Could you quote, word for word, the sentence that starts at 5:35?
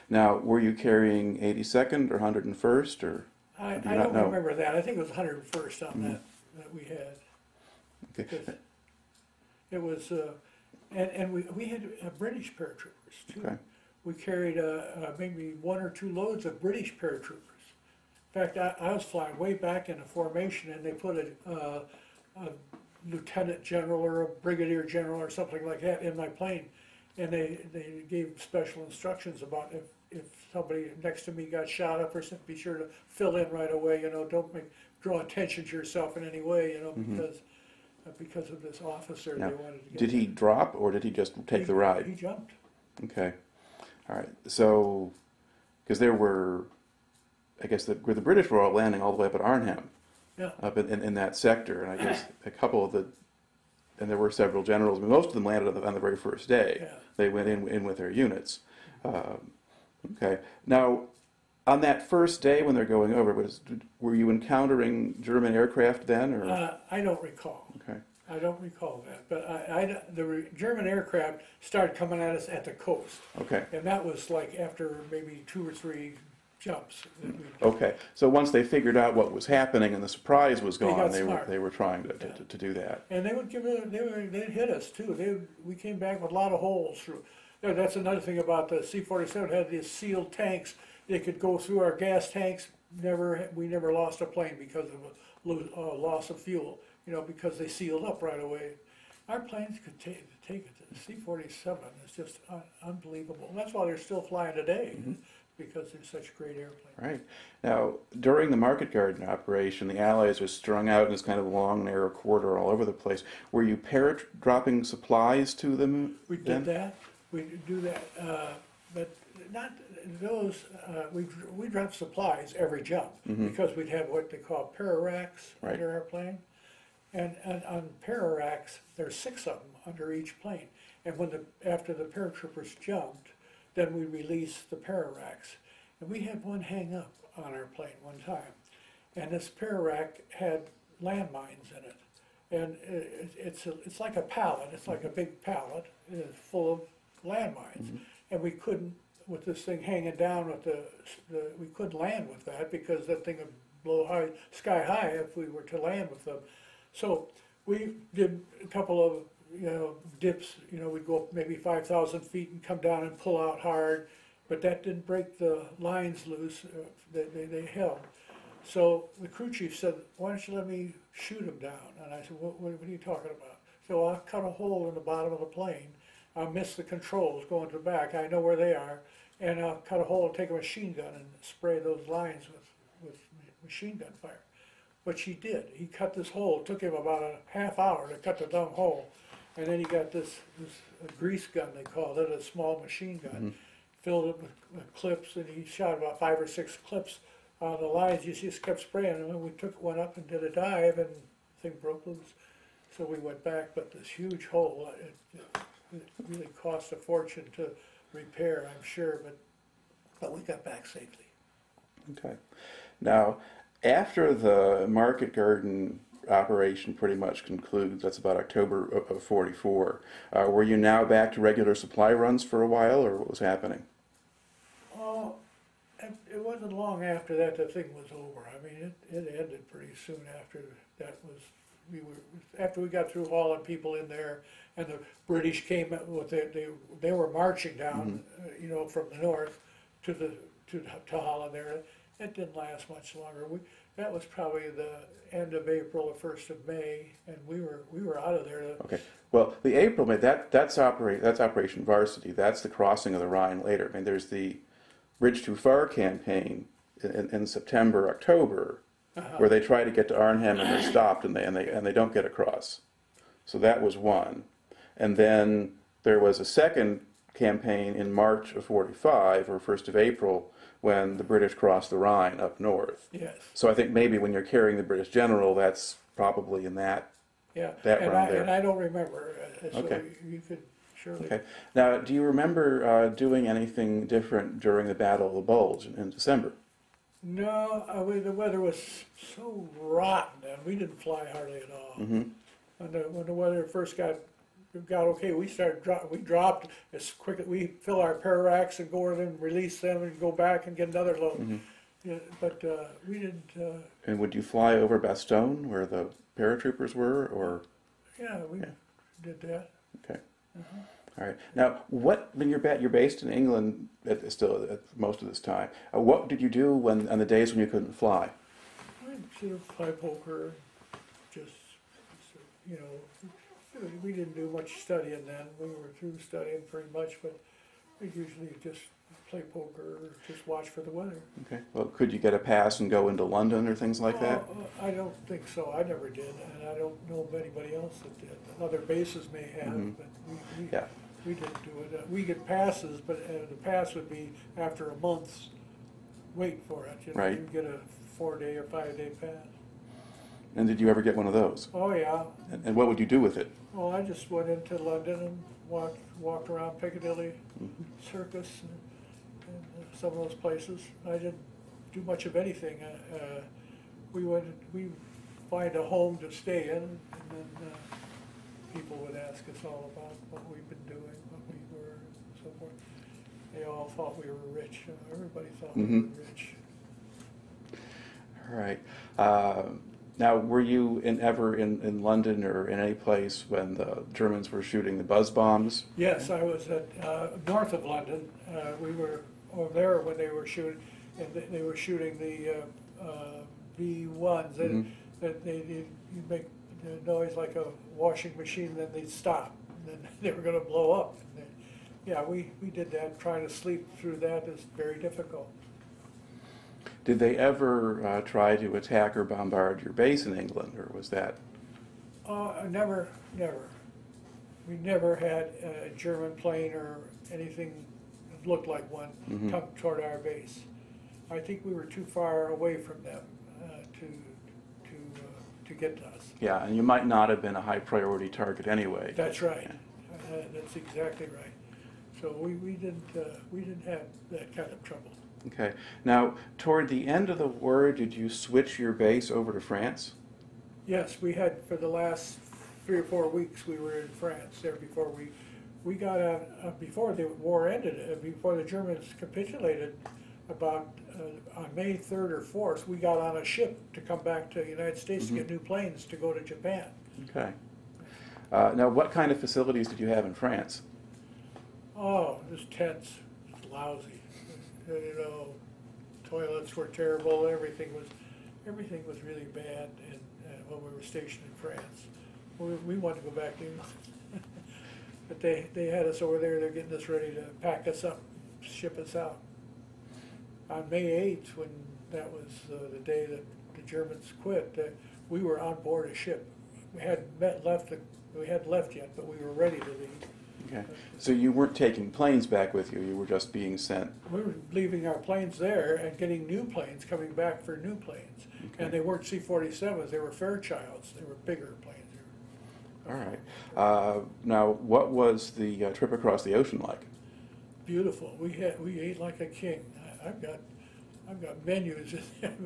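I never did, and I don't know of anybody else that did.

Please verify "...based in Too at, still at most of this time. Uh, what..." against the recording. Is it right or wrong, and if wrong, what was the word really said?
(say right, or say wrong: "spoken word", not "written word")
wrong: "England", not "Too".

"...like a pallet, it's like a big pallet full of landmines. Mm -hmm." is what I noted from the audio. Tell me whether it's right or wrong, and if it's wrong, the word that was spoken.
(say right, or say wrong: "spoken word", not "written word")
right.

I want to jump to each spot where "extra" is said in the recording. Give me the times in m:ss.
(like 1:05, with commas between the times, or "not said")
not said.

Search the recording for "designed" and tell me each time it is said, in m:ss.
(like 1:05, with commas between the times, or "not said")
not said.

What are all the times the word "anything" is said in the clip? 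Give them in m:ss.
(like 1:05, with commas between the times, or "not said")
4:43, 6:02, 6:57.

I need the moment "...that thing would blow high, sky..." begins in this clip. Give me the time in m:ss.
2:33.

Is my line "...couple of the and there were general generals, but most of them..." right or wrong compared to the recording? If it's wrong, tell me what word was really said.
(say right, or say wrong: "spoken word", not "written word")
wrong: "several", not "general".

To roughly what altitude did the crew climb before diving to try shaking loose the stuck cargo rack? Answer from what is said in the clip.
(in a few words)
5,000 feet.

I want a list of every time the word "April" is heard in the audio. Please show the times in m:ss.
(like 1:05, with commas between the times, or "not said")
4:05, 4:09, 4:29.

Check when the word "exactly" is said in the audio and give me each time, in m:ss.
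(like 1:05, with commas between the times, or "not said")
7:10.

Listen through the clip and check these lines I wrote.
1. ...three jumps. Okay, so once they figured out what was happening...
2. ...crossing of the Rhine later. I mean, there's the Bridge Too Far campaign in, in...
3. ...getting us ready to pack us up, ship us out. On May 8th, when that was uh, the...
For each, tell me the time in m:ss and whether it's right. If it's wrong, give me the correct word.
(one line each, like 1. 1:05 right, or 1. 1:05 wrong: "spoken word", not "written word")
1. 1:15 right
2. 4:12 right
3. 7:56 right.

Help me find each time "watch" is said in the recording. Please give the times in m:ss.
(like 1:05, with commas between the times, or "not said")
5:30.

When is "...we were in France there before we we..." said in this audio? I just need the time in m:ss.
7:23.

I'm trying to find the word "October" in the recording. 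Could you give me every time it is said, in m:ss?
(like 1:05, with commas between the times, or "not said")
3:38, 4:18.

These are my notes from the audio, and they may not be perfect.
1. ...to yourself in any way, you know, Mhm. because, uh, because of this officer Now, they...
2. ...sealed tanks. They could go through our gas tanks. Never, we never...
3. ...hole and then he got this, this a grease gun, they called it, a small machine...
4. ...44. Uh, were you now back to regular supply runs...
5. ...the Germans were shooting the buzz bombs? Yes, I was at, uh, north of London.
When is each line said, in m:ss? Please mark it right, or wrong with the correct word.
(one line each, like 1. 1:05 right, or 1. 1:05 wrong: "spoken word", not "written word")
1. 0:35 right
2. 1:29 right
3. 3:08 right
4. 3:39 right
5. 6:23 right.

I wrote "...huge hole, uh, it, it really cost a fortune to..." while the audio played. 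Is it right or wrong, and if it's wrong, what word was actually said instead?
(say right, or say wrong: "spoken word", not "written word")
right.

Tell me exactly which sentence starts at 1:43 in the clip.
That's why they're still flying today.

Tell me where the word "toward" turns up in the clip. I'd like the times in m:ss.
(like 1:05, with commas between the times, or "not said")
6:59, 7:16.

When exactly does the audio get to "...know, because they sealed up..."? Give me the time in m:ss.
1:37.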